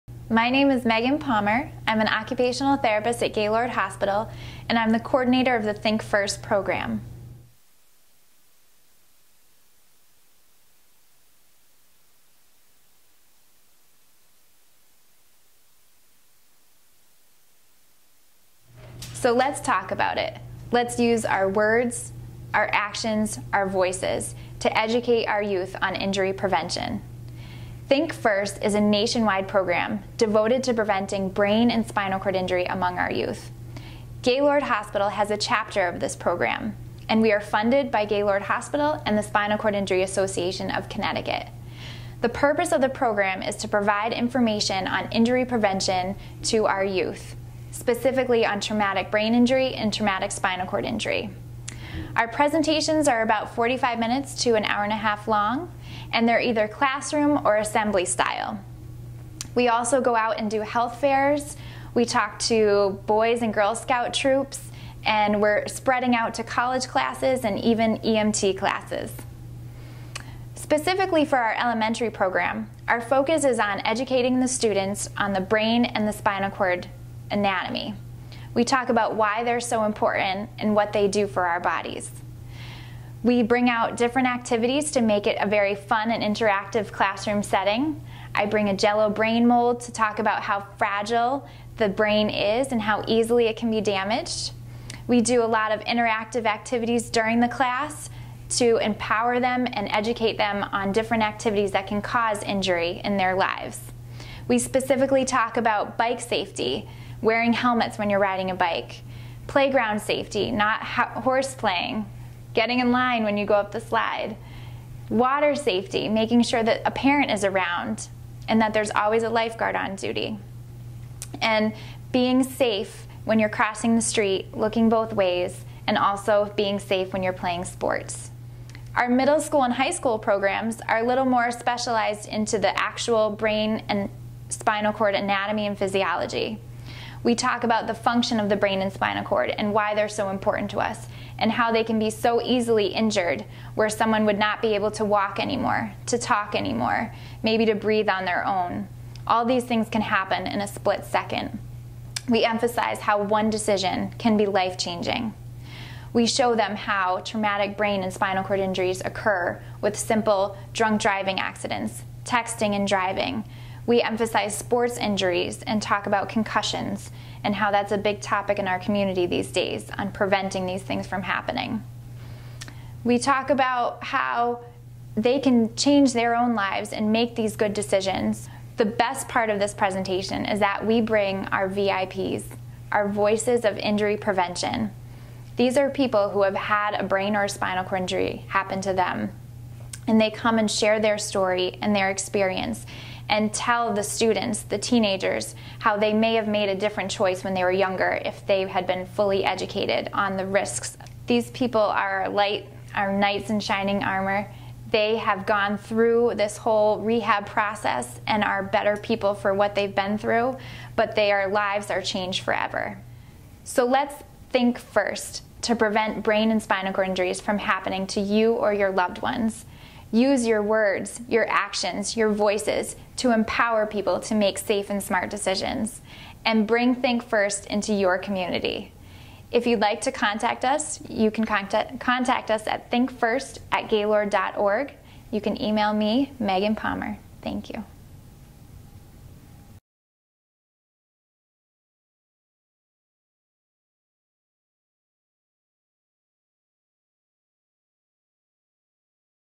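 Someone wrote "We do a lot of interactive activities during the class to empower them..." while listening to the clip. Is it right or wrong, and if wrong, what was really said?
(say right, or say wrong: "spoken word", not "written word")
right.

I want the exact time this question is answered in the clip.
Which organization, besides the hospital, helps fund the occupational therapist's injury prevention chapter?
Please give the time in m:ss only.
0:39.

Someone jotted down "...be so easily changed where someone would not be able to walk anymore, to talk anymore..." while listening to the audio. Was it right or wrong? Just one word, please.
wrong.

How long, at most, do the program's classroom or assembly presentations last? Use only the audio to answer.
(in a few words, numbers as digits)
An hour and a half.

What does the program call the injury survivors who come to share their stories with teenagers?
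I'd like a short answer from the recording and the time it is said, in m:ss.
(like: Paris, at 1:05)
VIPs, at 3:01.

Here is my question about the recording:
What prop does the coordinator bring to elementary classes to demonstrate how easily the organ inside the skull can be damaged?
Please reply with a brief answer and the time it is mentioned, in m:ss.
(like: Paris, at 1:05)
Jello brain mold, at 1:28.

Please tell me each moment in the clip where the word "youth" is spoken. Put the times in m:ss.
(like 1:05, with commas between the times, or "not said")
0:25, 0:33, 0:46.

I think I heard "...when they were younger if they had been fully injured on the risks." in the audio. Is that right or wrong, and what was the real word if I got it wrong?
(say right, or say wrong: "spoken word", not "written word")
wrong: "educated", not "injured".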